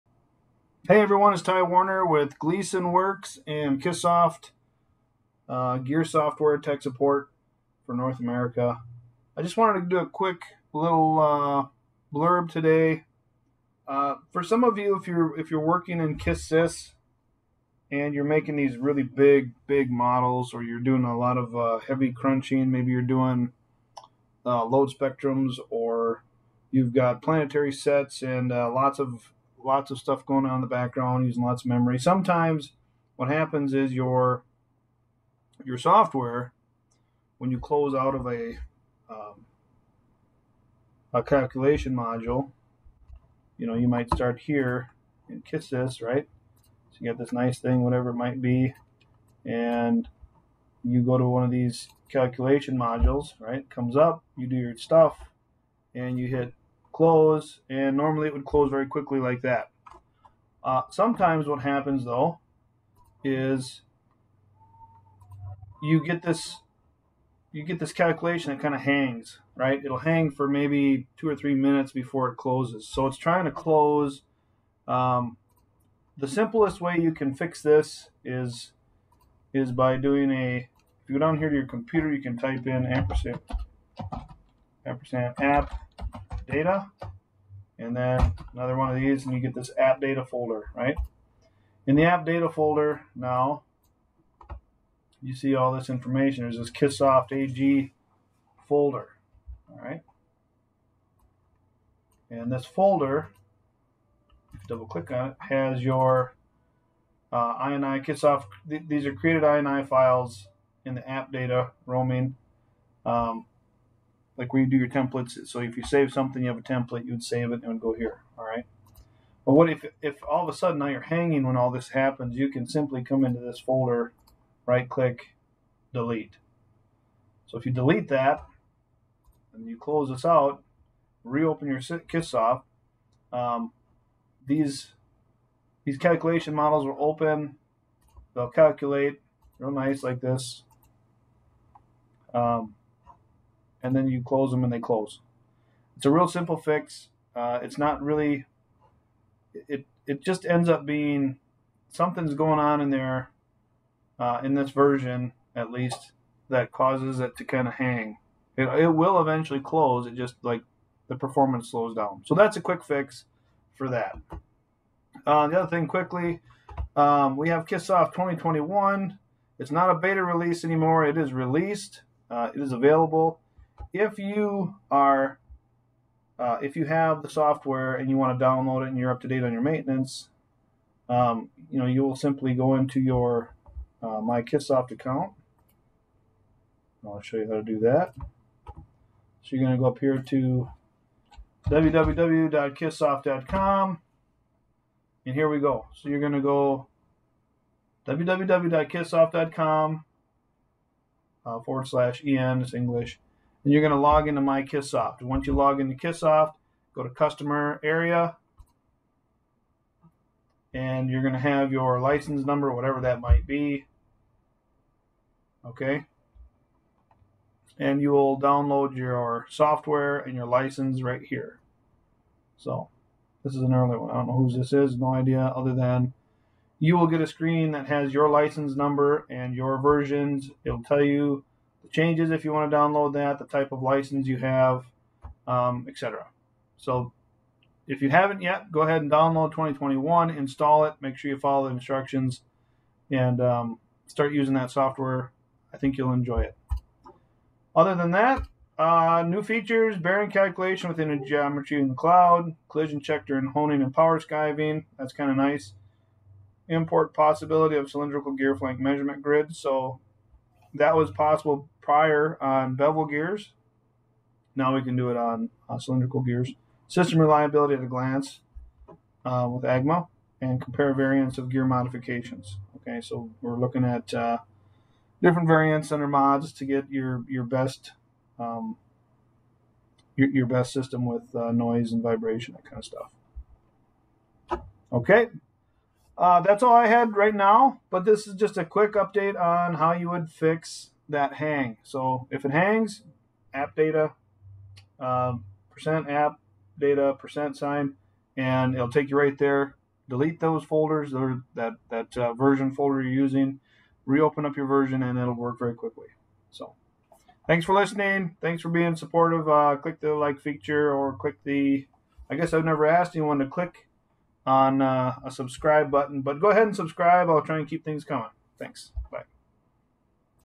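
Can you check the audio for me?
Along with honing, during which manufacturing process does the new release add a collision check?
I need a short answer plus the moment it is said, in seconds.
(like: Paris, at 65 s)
power skiving, at 253 s.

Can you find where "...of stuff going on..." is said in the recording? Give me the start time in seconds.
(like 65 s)
29 s.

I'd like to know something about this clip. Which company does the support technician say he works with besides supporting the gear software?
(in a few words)
Gleason Works.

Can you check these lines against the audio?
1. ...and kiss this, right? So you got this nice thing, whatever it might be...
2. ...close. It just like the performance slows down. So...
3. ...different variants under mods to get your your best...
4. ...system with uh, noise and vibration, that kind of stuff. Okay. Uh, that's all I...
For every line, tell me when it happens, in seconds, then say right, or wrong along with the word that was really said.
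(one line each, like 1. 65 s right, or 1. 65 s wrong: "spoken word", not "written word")
1. 45 s right
2. 159 s right
3. 275 s right
4. 280 s right.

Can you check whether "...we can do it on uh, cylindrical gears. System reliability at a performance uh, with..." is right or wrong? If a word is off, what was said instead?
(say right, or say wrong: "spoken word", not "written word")
wrong: "glance", not "performance".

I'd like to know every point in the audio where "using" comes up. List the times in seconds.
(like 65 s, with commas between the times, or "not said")
31 s, 244 s, 303 s.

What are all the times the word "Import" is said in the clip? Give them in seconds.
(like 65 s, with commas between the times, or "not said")
256 s.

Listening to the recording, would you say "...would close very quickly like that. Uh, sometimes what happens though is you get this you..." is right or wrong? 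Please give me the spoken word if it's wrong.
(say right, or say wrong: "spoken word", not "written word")
right.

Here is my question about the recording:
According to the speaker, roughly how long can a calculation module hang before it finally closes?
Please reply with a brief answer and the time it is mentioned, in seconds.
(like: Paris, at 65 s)
2 or 3 minutes, at 71 s.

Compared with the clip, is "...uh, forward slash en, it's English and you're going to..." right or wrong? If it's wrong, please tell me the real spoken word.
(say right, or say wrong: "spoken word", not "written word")
right.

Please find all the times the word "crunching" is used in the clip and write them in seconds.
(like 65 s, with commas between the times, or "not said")
22 s.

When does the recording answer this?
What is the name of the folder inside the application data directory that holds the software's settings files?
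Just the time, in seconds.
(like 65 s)
96 s.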